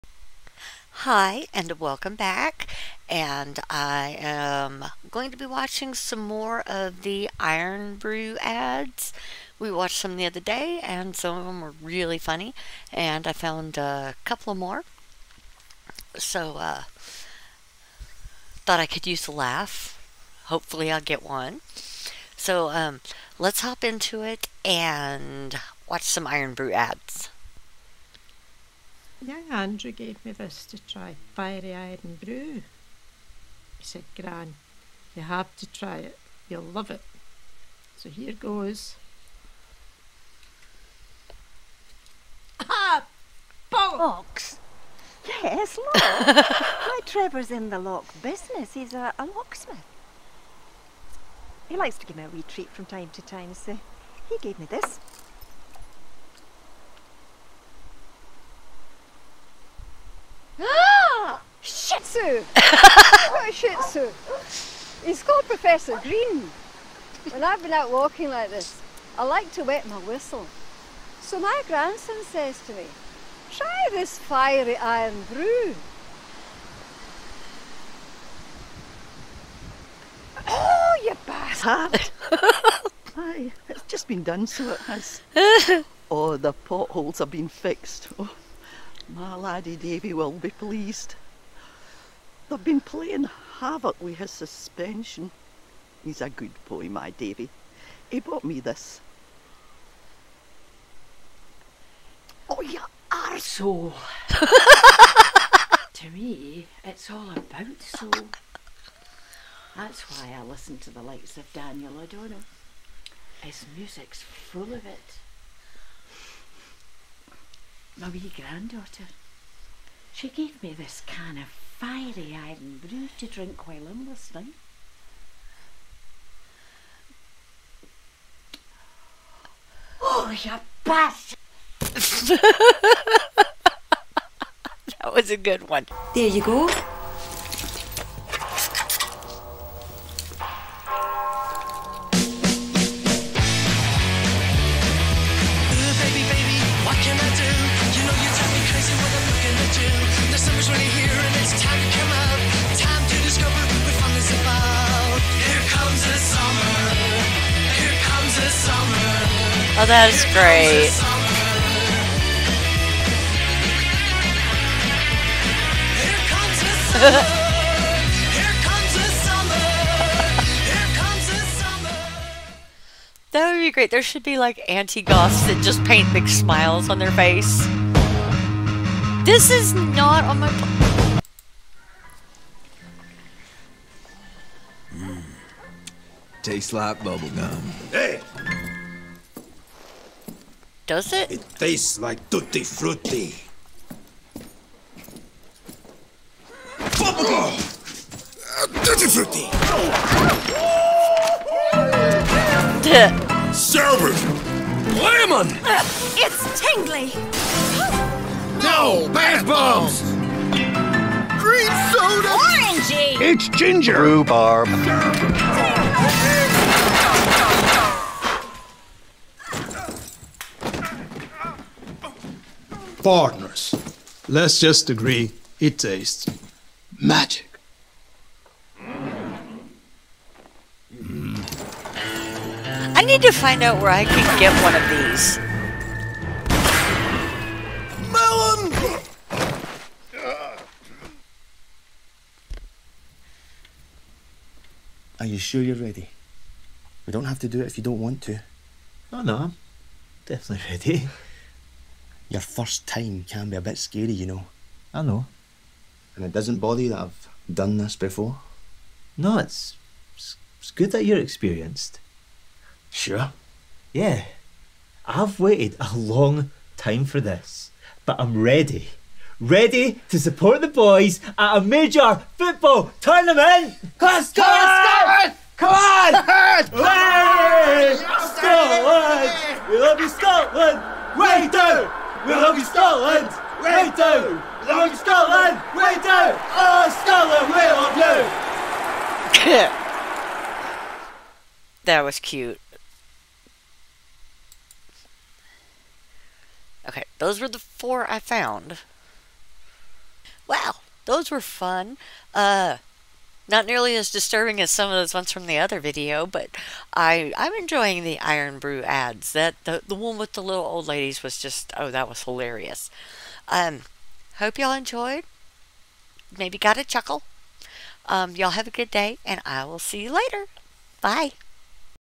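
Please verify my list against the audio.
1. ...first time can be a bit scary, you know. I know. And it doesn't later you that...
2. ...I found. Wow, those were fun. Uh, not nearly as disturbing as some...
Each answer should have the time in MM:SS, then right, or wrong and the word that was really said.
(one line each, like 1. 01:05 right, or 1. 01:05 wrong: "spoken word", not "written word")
1. 04:12 wrong: "bother", not "later"
2. 04:58 right.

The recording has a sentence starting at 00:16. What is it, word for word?
So uh, thought I could use a laugh.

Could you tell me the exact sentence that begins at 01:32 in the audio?
They've been playing havoc with his suspension.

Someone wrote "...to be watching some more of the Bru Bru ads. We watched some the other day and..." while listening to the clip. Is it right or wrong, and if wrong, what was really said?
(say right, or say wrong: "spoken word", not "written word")
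wrong: "Irn", not "Bru".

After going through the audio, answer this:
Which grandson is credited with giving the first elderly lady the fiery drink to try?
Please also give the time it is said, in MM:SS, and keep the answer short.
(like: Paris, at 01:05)
Andrew, at 00:29.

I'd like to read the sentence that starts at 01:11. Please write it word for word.
So my grandson says to me, try this fiery Irn Bru.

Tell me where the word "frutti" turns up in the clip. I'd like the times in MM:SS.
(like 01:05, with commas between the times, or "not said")
03:12, 03:19.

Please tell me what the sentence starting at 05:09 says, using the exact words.
That the, the one with the little old ladies was just, oh, that was hilarious.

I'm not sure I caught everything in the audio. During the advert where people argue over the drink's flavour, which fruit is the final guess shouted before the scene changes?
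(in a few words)
Melon.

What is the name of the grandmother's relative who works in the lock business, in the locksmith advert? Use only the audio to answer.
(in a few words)
Trevor.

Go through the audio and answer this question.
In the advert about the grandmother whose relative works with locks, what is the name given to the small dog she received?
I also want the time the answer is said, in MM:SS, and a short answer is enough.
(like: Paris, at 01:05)
Professor Green, at 01:05.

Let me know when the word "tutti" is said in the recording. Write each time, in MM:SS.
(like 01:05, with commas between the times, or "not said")
03:12, 03:18.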